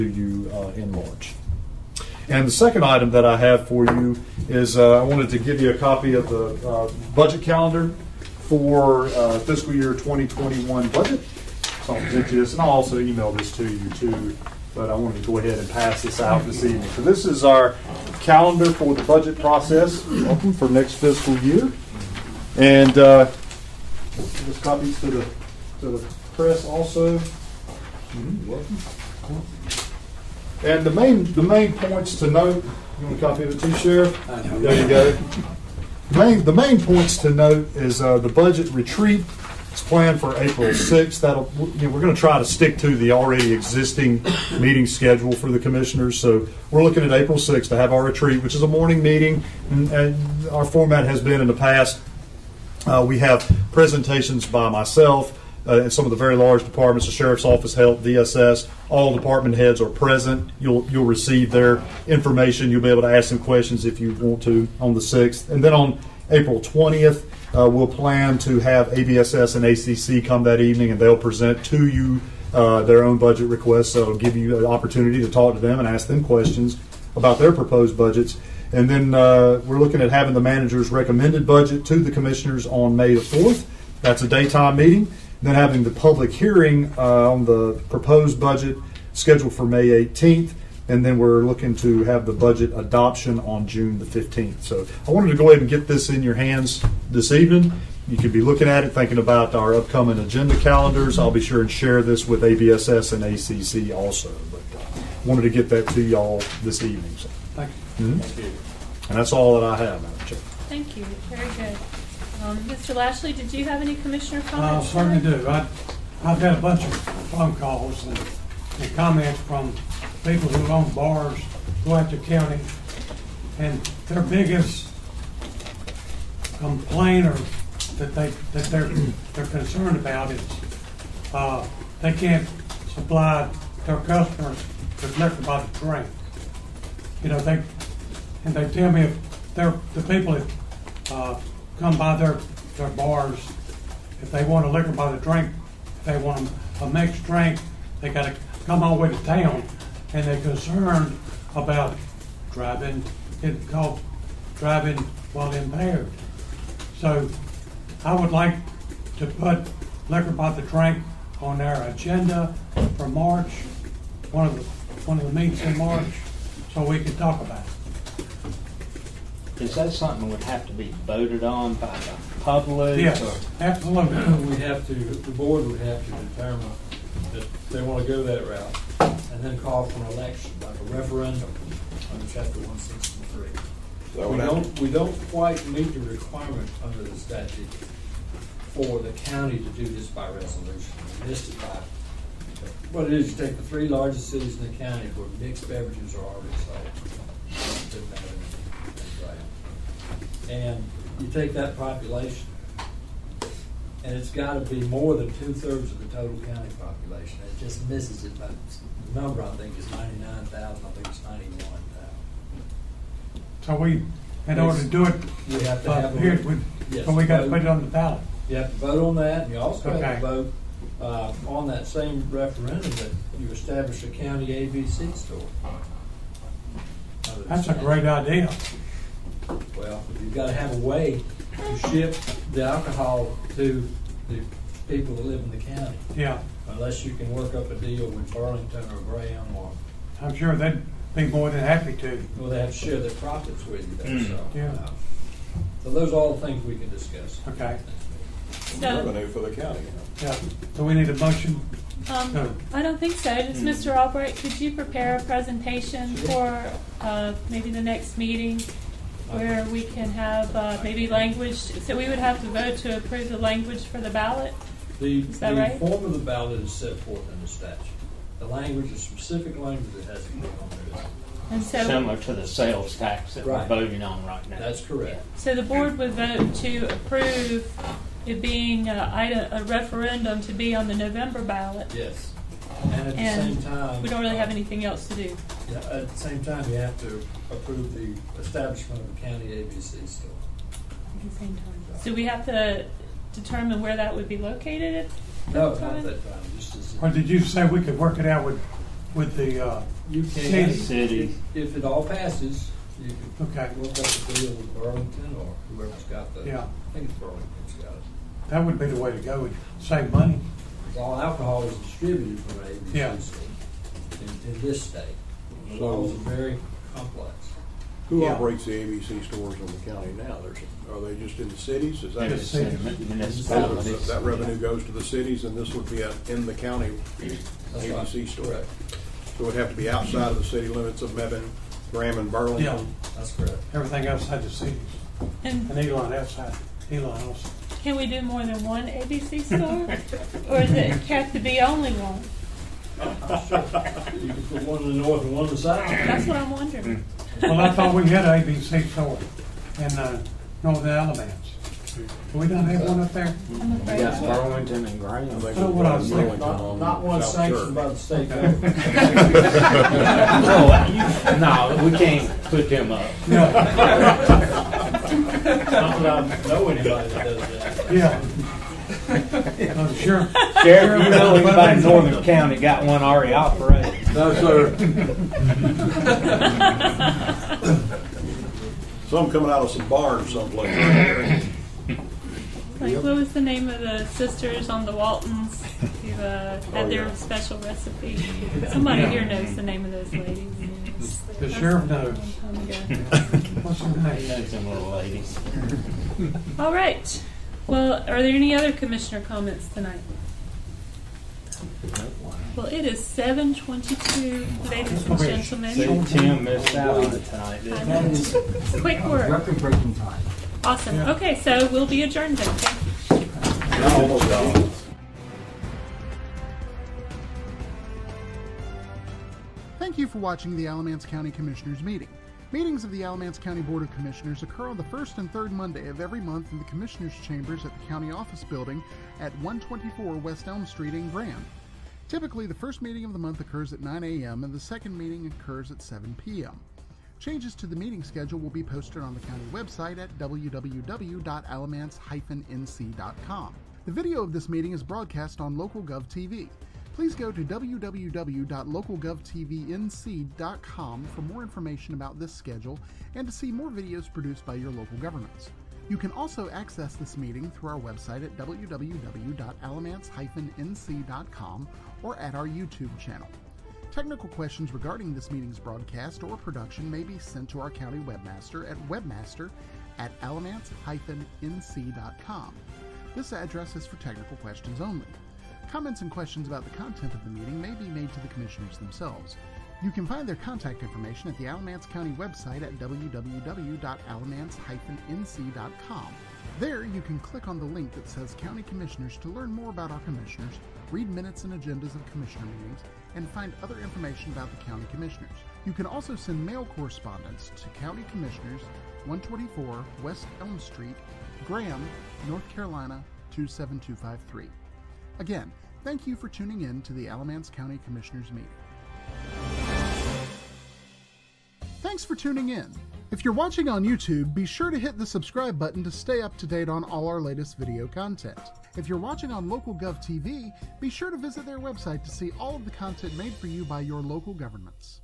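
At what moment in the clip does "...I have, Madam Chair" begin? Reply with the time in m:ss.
1:49.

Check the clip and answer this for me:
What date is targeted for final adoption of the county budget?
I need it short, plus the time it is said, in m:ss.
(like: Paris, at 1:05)
June 15th, at 1:33.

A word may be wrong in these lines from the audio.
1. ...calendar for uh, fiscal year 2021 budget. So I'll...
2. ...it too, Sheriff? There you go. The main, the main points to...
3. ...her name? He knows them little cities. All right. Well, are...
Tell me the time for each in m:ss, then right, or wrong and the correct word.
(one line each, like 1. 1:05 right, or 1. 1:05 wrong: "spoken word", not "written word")
1. 0:07 right
2. 0:33 right
3. 6:33 wrong: "ladies", not "cities".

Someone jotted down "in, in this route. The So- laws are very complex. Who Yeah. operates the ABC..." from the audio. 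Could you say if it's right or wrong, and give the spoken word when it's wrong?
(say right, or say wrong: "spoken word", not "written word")
wrong: "state", not "route".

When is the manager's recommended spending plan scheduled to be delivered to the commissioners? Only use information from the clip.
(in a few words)
May 4th.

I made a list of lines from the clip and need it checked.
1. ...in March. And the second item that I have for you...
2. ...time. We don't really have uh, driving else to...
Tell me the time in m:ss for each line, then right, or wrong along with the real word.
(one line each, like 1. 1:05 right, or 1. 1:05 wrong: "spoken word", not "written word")
1. 0:00 right
2. 4:43 wrong: "anything", not "driving".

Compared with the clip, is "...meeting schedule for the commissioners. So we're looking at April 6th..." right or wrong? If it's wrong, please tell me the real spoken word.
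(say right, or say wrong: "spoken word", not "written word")
right.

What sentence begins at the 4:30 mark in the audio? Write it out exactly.
is- And so, similar to the sales tax that we're voting on right now.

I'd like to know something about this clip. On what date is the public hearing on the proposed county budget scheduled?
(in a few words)
May 18th.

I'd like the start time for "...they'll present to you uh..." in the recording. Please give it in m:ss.
1:10.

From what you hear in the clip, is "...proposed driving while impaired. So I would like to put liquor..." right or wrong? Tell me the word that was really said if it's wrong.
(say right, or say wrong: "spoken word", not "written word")
wrong: "called", not "proposed".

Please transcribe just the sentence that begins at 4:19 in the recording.
where we can have uh, maybe language, so we would have to vote to approve the language for the ballot?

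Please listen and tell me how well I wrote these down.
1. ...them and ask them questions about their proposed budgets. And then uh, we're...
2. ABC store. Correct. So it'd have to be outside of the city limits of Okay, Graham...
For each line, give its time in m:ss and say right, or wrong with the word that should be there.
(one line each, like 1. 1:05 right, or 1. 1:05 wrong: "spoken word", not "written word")
1. 1:15 right
2. 5:27 wrong: "Mebane", not "Okay".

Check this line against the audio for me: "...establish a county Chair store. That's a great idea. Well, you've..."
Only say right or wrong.
wrong.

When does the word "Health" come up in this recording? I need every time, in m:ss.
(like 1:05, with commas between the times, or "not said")
0:57.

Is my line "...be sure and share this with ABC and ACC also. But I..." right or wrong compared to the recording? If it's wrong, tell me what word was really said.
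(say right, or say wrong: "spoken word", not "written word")
wrong: "ABSS", not "ABC".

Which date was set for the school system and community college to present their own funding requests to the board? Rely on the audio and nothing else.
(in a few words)
April 20th.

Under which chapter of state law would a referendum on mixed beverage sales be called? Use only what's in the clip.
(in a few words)
Chapter 163.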